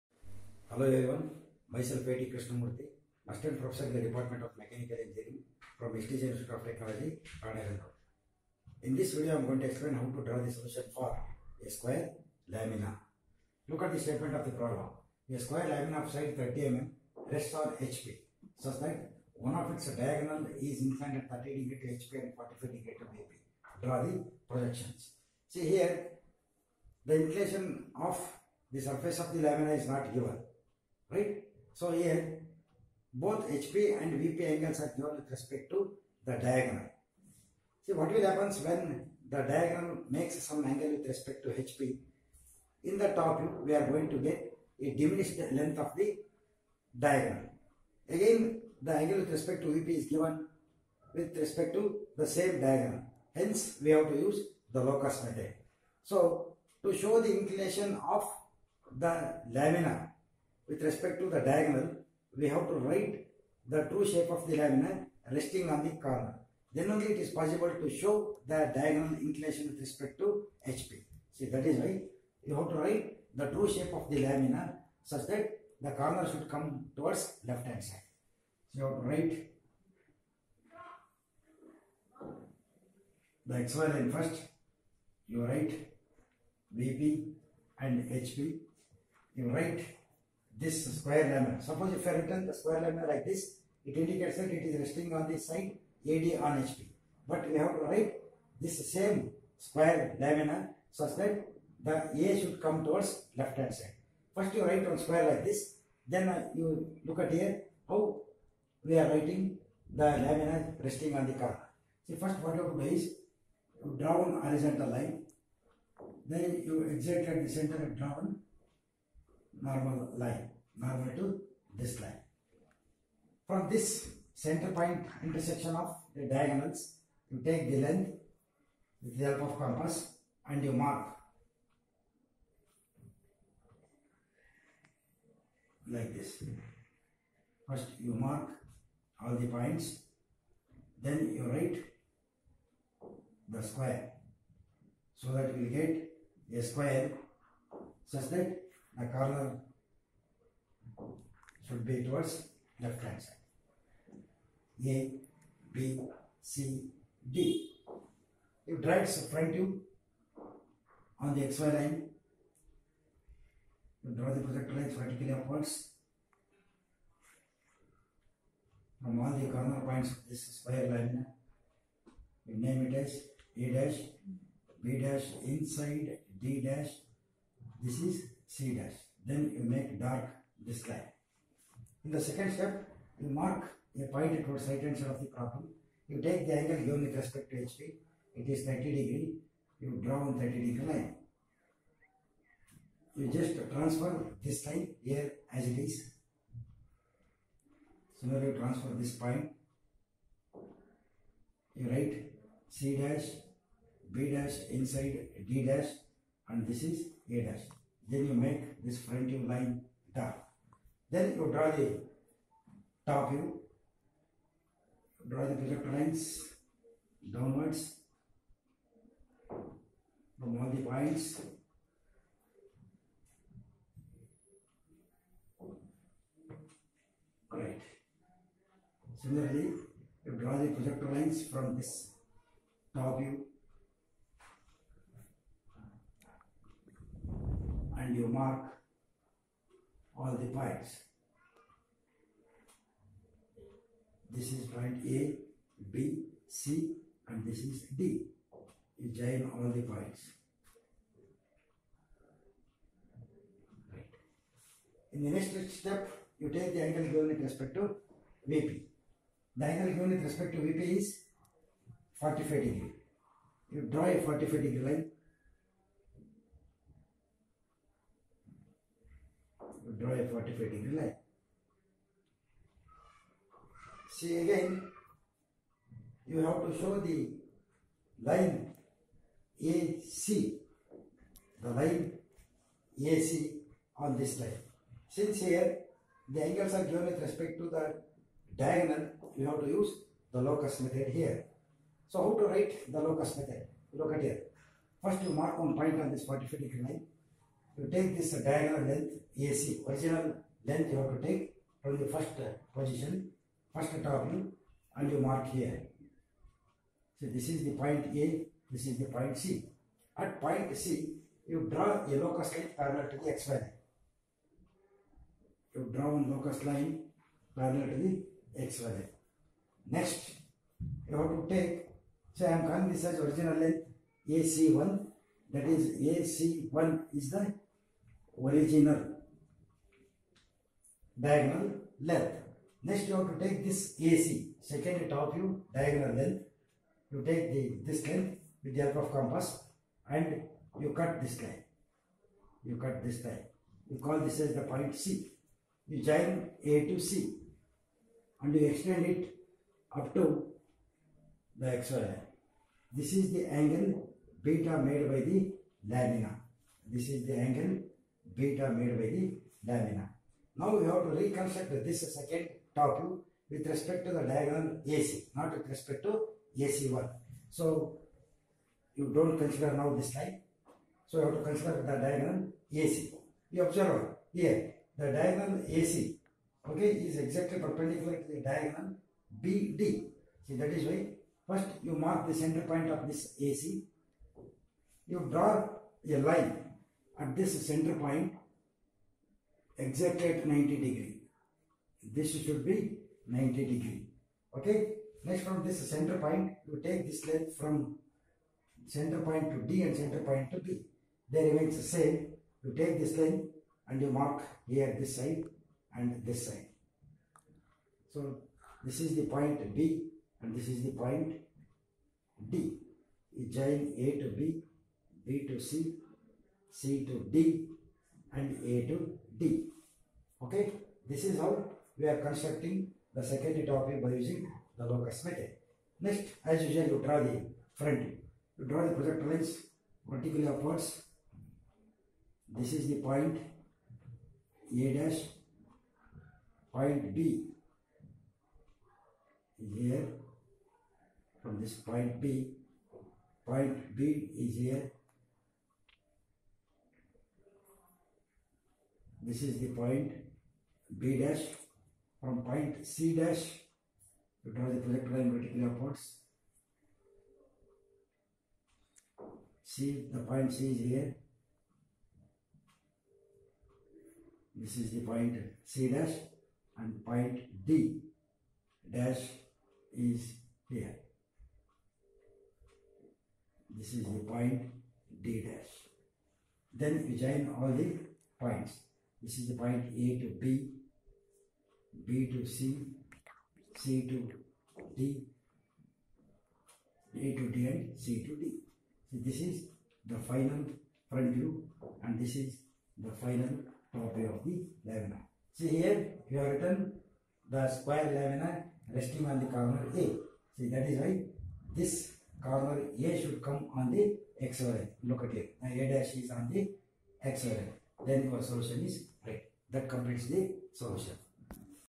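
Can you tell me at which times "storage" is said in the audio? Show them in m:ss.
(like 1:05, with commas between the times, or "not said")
not said.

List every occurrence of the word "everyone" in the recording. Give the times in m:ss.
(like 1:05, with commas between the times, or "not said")
0:00.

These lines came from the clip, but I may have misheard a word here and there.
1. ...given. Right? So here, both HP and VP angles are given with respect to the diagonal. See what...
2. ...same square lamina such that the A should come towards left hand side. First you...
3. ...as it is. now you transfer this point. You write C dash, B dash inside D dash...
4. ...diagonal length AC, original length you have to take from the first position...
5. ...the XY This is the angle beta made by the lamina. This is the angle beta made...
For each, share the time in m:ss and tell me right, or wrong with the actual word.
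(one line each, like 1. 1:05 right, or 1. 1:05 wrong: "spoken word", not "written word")
1. 0:30 right
2. 1:38 right
3. 3:15 right
4. 4:58 right
5. 5:51 right.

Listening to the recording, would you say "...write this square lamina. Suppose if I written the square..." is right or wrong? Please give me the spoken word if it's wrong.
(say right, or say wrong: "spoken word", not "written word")
right.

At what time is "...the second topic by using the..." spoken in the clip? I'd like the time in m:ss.
7:03.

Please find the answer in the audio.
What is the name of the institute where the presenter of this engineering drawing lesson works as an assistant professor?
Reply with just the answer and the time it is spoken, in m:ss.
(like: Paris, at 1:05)
STJ Institute of Technology, at 0:05.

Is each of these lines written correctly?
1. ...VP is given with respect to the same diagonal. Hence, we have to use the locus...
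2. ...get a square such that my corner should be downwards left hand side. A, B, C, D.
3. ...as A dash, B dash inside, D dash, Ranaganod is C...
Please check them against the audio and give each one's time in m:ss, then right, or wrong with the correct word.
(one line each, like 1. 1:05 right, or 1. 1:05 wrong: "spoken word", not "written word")
1. 0:49 right
2. 2:25 wrong: "towards", not "downwards"
3. 2:52 wrong: "This", not "Ranaganod".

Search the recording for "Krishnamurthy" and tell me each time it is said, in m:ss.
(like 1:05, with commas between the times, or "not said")
0:02.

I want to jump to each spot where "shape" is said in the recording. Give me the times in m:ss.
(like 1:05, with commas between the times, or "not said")
1:04, 1:13.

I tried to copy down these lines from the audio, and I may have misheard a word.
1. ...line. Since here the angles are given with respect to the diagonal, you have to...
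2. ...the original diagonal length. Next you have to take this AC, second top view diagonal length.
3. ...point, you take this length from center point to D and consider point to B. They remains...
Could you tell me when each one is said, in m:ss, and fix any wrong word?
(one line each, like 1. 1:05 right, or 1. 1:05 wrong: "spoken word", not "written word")
1. 4:44 right
2. 5:27 right
3. 6:36 wrong: "center", not "consider".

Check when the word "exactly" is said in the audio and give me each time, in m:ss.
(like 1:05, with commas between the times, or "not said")
6:17, 6:29.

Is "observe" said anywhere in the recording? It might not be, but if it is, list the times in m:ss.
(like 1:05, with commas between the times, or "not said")
6:13.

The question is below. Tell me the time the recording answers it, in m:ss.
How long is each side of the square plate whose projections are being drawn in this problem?
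0:16.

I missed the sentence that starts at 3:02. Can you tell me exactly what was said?
In the second step, you mark a point towards right hand side of the problem.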